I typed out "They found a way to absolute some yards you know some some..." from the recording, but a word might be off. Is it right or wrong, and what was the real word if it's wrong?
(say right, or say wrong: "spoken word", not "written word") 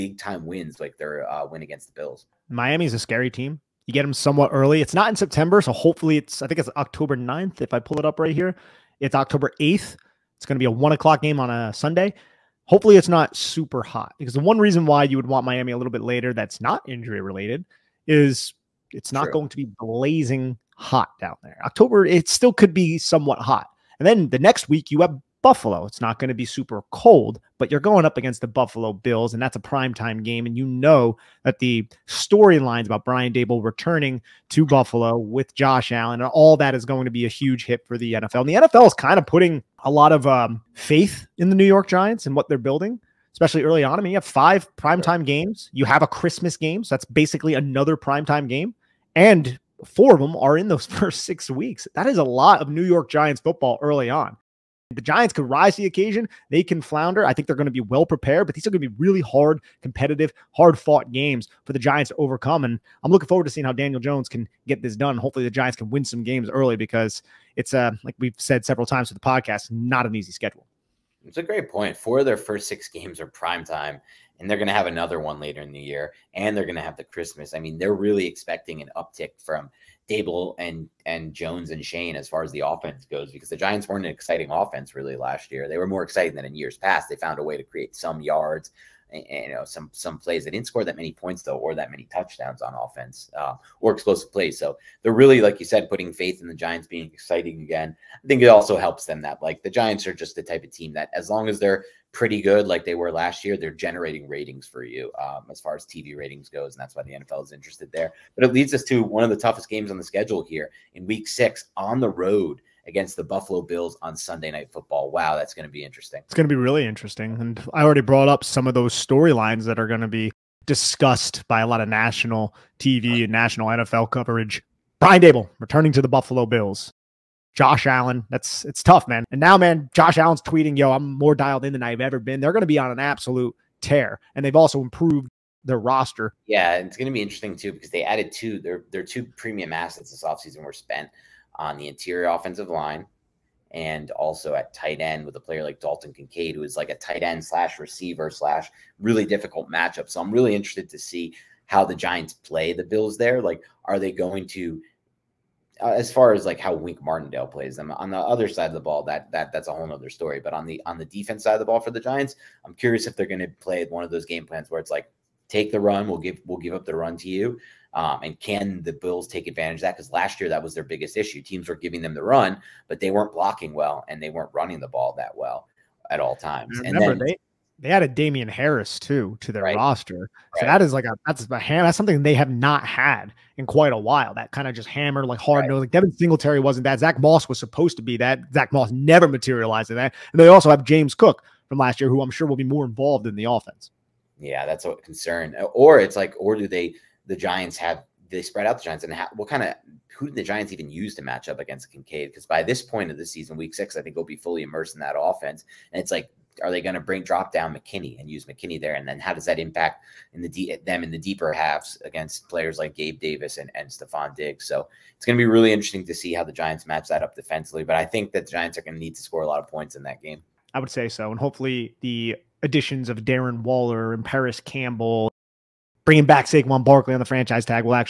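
wrong: "create", not "absolute".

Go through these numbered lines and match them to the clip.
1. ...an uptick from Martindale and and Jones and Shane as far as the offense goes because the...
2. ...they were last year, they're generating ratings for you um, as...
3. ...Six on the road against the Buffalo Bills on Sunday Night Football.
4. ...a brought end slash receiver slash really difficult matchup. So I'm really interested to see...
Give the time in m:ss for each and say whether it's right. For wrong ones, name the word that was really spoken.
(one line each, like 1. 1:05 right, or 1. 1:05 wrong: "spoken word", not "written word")
1. 1:18 wrong: "Daboll", not "Martindale"
2. 1:42 right
3. 1:51 right
4. 2:26 wrong: "tight", not "brought".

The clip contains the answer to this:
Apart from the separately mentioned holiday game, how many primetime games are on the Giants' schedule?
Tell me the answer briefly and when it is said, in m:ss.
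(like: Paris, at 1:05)
5, at 0:44.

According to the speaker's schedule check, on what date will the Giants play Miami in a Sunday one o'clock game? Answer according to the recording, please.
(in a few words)
October 8th.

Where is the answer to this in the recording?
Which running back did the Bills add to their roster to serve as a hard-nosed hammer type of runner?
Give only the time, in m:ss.
2:58.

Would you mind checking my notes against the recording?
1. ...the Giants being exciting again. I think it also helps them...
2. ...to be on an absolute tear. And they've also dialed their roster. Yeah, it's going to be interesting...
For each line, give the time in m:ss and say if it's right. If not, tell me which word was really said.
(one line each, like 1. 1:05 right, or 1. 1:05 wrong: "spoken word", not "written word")
1. 1:36 right
2. 2:12 wrong: "improved", not "dialed".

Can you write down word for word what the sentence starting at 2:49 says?
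Because last year that was their biggest issue.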